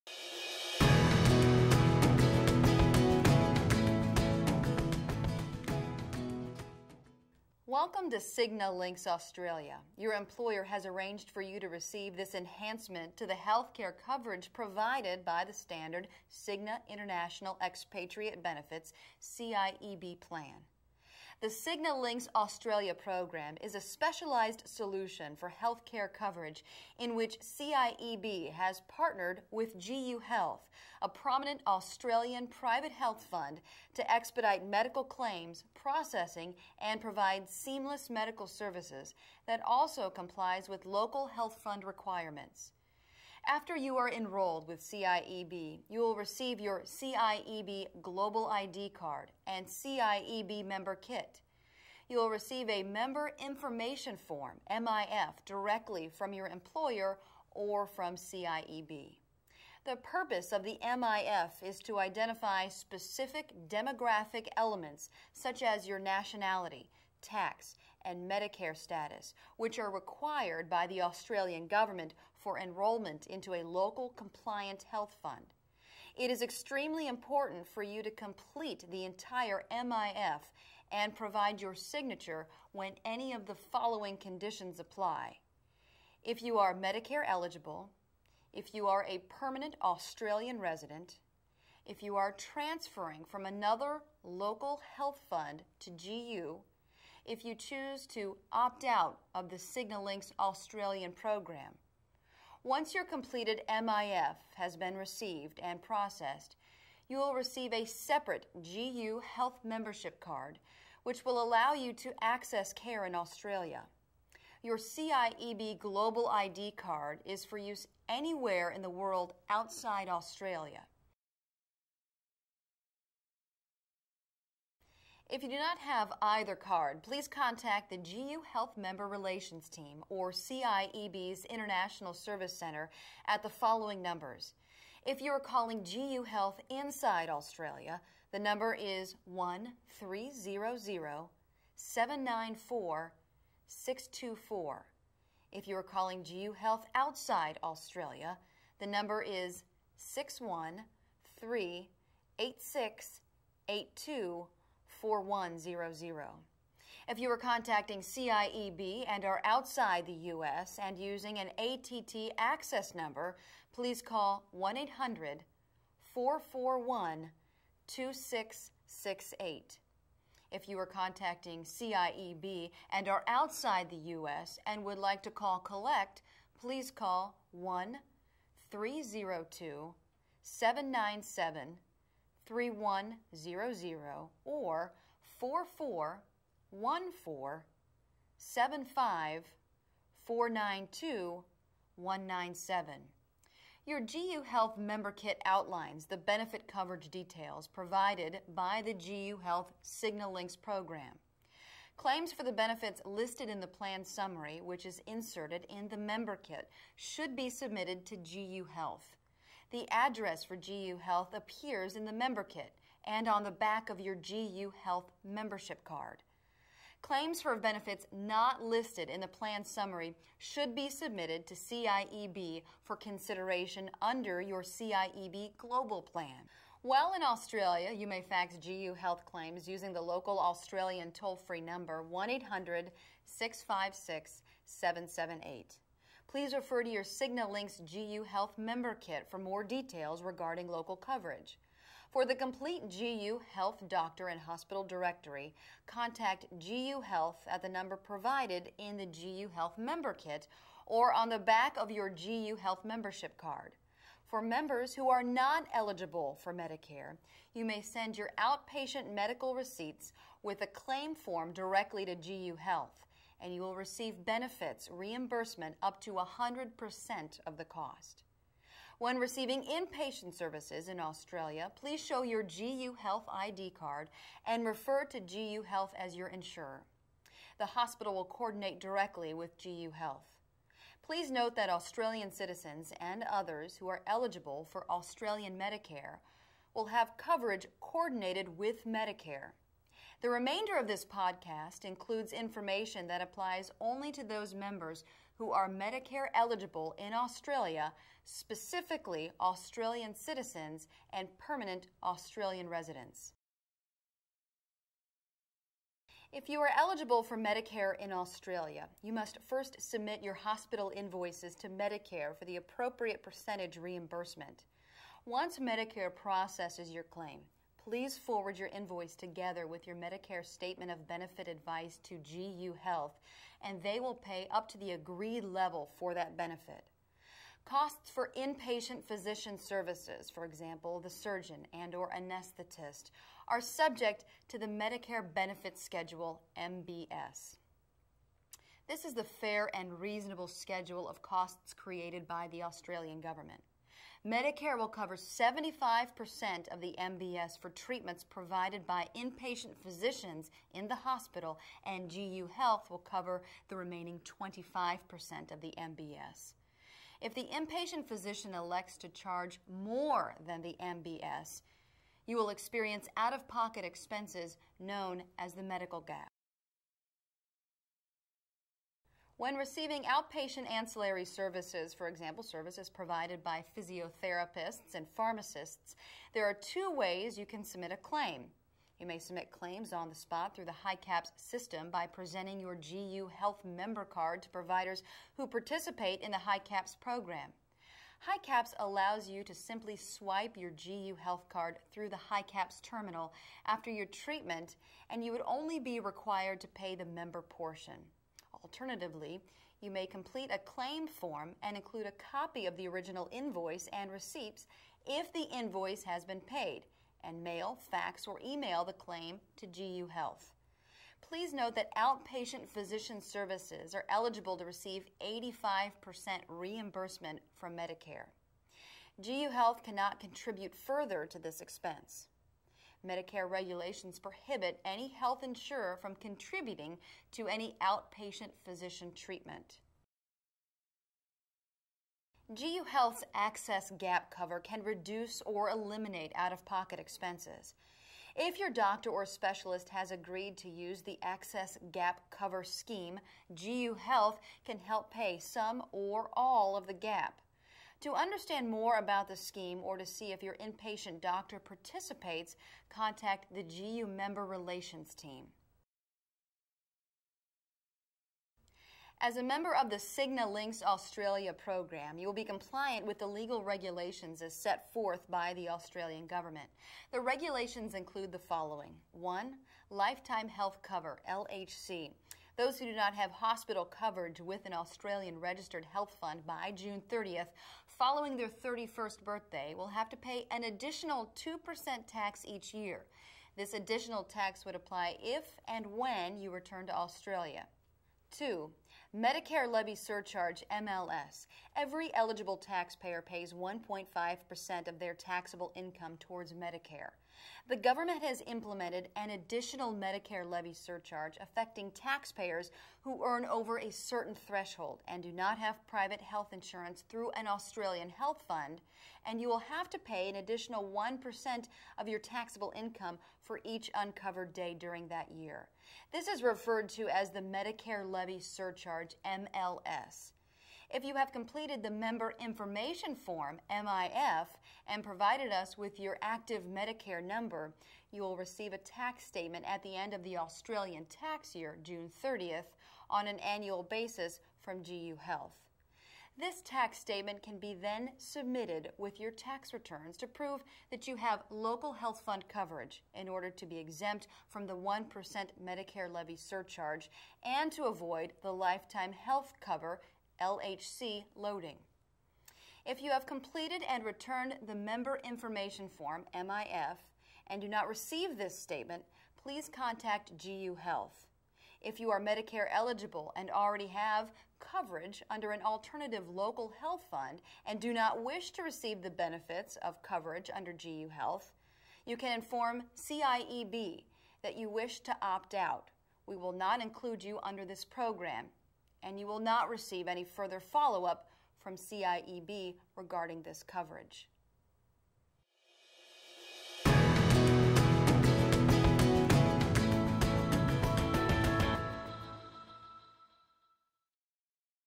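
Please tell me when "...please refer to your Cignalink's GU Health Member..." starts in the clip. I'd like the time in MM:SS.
03:56.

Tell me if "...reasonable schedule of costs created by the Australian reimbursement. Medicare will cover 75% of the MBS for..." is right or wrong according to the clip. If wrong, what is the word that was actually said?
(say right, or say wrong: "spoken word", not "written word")
wrong: "government", not "reimbursement".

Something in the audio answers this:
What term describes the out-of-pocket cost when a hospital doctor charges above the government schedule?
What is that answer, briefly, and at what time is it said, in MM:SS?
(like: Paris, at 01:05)
medical gap, at 06:05.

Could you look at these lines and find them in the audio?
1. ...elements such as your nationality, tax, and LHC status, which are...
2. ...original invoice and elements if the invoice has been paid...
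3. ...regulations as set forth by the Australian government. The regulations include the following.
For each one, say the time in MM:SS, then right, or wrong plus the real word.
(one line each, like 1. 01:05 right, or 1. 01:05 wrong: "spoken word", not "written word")
1. 01:04 wrong: "Medicare", not "LHC"
2. 06:42 wrong: "receipts", not "elements"
3. 07:43 right.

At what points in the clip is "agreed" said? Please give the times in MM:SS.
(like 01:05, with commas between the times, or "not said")
05:24, 07:20.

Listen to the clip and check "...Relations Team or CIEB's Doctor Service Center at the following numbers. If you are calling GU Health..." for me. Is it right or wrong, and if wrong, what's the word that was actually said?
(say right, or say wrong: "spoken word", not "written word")
wrong: "International", not "Doctor".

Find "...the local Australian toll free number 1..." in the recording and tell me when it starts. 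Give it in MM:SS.
03:49.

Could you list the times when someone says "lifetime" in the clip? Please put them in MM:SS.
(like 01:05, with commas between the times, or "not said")
07:49, 09:08.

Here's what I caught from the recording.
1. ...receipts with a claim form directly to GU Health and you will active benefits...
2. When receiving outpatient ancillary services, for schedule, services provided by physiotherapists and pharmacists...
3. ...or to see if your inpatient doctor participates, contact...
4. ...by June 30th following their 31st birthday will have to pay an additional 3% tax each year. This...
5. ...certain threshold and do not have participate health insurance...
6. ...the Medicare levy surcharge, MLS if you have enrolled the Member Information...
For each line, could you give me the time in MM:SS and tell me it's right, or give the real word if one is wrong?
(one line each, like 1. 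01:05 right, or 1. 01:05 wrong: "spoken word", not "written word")
1. 04:19 wrong: "receive", not "active"
2. 06:09 wrong: "example", not "schedule"
3. 07:29 right
4. 07:56 wrong: "2", not "3"
5. 08:23 wrong: "private", not "participate"
6. 08:37 wrong: "completed", not "enrolled".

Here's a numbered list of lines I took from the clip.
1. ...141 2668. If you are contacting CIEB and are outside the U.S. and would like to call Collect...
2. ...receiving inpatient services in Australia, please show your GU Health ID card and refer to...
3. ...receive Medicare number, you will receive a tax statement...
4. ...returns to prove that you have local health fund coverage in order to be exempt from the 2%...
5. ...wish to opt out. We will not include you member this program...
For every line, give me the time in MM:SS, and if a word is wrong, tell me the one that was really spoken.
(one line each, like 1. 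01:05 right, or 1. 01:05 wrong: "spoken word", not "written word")
1. 02:46 wrong: "441", not "141"
2. 04:29 right
3. 08:46 wrong: "active", not "receive"
4. 08:59 wrong: "1", not "2"
5. 09:34 wrong: "under", not "member".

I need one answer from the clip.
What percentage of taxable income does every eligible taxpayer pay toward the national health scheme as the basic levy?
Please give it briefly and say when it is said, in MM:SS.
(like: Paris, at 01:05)
1.5%, at 08:13.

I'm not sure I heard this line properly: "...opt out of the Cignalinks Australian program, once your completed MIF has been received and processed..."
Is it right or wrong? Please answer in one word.
right.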